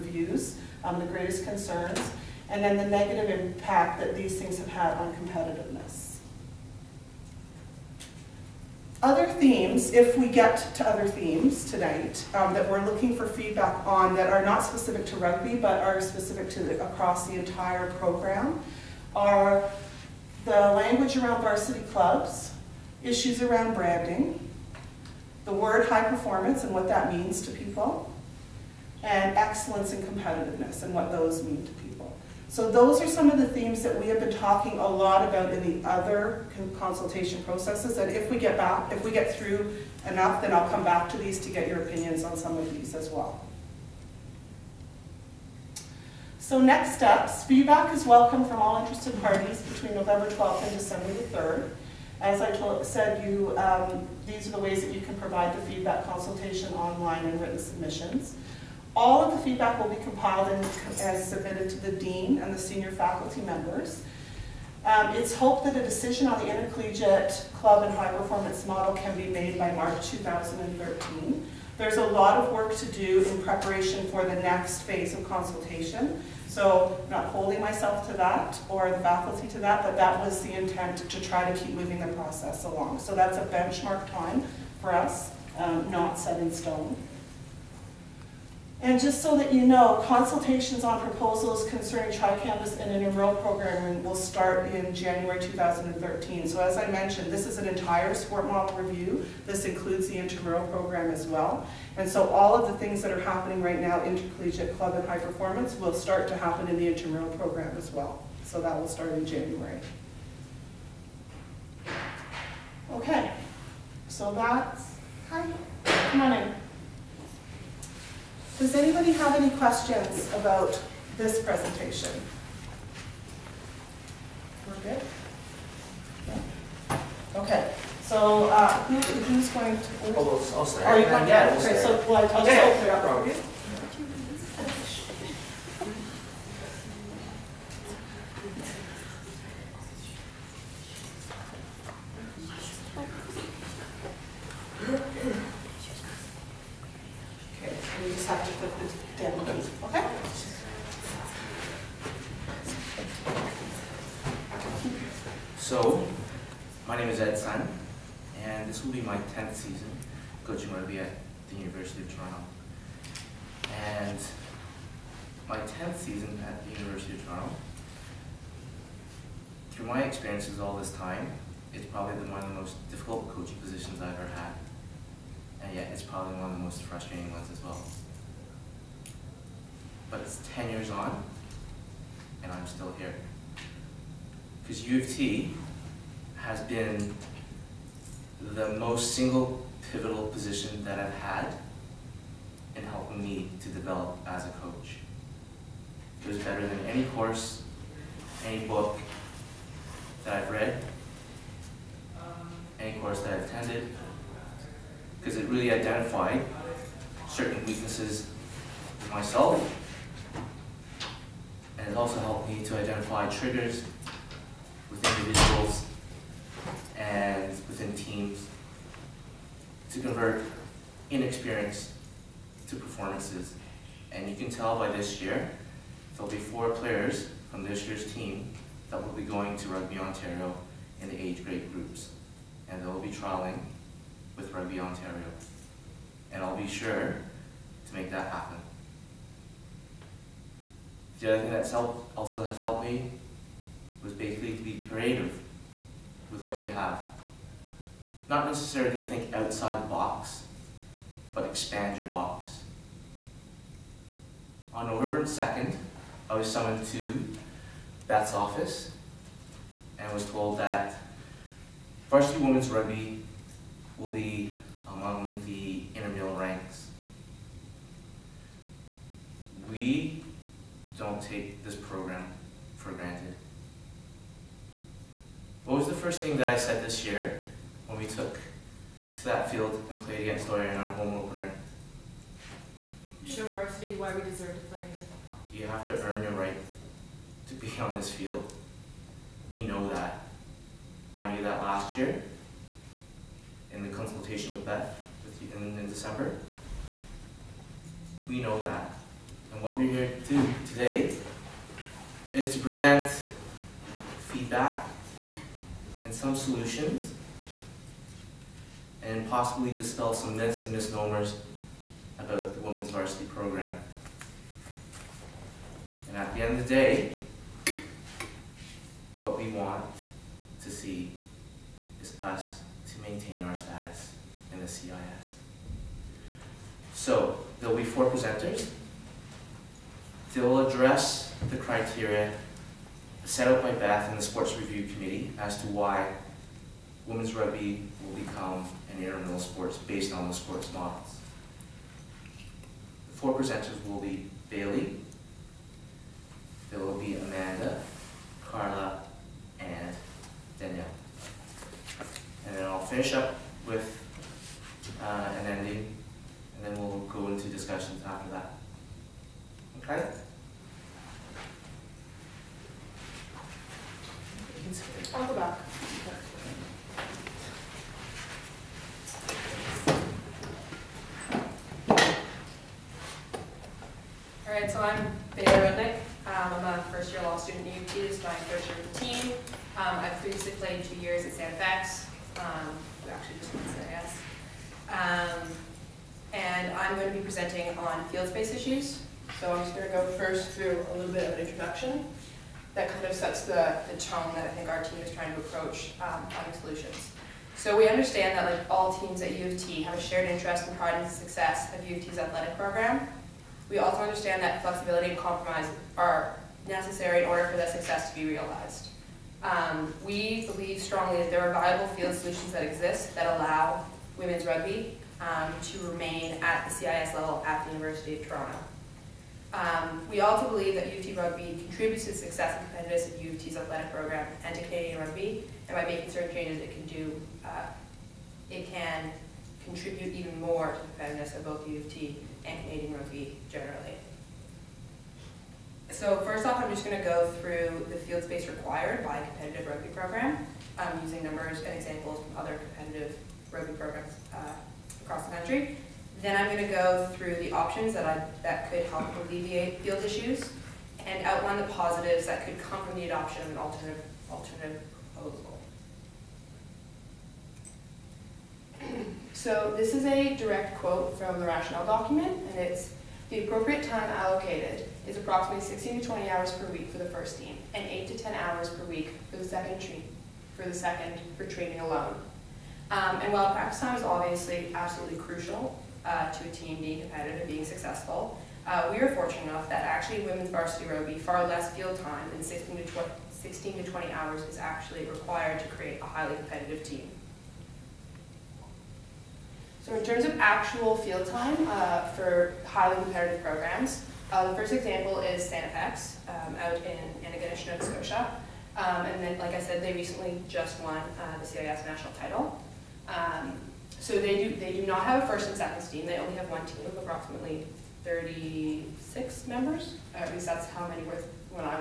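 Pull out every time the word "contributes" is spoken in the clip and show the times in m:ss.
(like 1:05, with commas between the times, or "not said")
7:01, 7:09.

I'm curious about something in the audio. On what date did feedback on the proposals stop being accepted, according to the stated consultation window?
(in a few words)
December 3rd.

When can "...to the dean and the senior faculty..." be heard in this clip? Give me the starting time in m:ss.
1:01.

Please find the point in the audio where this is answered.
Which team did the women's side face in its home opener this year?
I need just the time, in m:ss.
4:40.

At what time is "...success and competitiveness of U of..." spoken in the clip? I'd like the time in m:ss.
7:02.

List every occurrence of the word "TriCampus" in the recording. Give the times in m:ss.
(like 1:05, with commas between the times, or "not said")
1:32.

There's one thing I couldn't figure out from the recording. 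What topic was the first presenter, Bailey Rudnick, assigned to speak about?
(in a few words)
Field space issues.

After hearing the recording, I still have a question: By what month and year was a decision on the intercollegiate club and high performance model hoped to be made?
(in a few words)
March 2013.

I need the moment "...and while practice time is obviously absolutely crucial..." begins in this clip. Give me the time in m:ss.
7:53.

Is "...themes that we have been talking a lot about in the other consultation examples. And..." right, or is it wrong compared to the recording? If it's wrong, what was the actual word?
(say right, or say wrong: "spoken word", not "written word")
wrong: "processes", not "examples".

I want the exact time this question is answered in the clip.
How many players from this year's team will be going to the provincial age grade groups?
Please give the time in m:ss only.
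3:46.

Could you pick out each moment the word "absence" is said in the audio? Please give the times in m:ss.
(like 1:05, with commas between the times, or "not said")
not said.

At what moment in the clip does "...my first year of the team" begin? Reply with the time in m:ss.
6:18.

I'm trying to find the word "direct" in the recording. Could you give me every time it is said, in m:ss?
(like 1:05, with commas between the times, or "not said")
7:40.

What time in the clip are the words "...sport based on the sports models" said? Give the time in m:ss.
5:39.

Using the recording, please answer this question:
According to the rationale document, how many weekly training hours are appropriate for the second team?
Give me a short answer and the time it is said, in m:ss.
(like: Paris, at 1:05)
8 to 10 hours, at 7:47.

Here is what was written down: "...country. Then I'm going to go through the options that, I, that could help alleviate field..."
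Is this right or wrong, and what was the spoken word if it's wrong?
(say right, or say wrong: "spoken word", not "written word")
right.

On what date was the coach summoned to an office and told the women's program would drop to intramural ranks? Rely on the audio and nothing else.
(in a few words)
November 2nd.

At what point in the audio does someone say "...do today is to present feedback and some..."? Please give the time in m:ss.
5:00.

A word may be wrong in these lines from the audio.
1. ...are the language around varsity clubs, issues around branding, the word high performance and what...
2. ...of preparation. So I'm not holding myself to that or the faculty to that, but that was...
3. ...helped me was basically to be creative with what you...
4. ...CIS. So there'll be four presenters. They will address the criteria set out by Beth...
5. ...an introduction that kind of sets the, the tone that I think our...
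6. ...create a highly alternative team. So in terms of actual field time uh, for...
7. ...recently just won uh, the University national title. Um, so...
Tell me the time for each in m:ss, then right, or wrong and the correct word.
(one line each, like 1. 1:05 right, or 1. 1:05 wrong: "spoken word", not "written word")
1. 0:19 right
2. 1:15 wrong: "consultation", not "preparation"
3. 4:02 right
4. 5:24 right
5. 6:31 right
6. 8:05 wrong: "competitive", not "alternative"
7. 8:19 wrong: "CIS", not "University".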